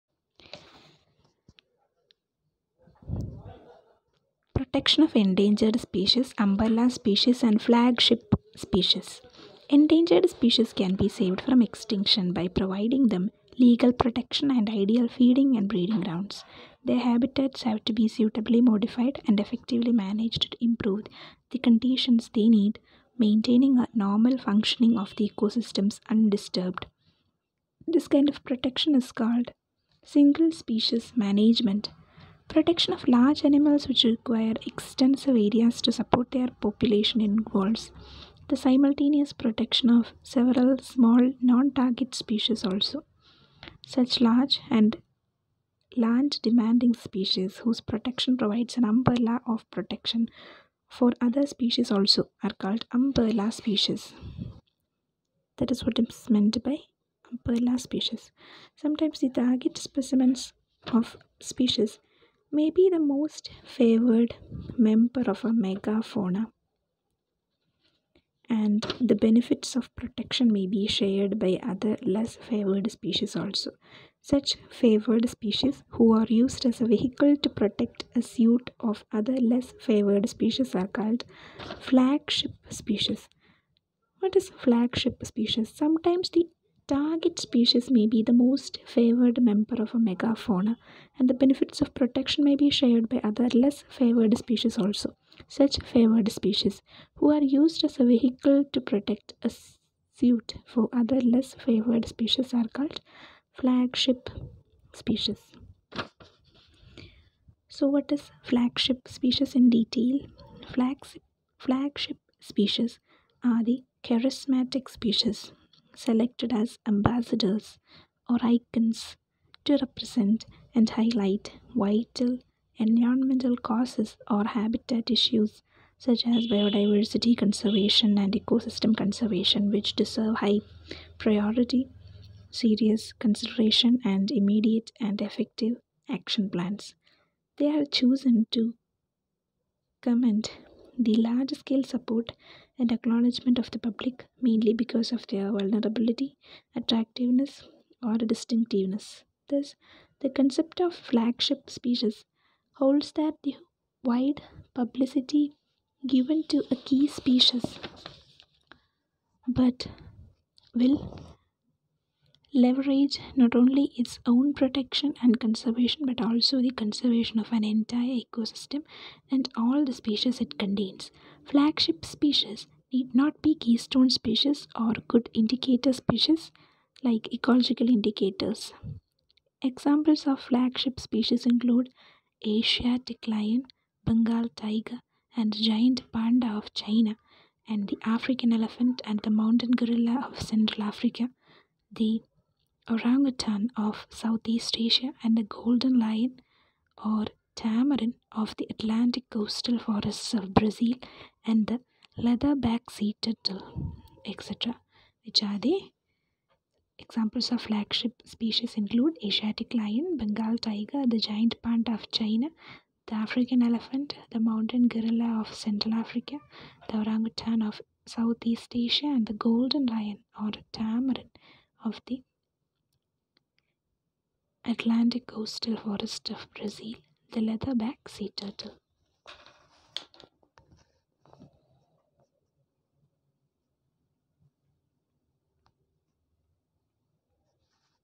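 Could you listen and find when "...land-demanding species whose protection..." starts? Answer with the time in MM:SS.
00:45.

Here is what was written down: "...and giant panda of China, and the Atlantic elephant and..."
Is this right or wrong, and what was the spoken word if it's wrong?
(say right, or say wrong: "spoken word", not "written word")
wrong: "African", not "Atlantic".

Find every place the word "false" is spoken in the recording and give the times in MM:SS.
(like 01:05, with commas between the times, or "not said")
not said.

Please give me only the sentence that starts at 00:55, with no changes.
That is what is meant by umbrella species.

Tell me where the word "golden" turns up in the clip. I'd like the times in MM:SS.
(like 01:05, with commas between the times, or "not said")
03:15, 03:39.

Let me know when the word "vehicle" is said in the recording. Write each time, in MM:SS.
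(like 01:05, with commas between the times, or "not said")
01:16, 01:38.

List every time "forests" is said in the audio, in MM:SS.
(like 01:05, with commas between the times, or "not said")
03:19, 03:45.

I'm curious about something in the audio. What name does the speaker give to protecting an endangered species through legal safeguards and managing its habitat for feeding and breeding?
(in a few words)
single species management.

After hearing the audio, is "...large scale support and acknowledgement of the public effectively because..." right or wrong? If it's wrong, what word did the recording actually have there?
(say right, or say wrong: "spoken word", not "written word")
wrong: "mainly", not "effectively".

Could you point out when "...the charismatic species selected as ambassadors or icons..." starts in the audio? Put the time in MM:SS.
01:53.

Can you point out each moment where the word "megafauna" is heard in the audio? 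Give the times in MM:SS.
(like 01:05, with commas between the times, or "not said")
01:05, 01:29.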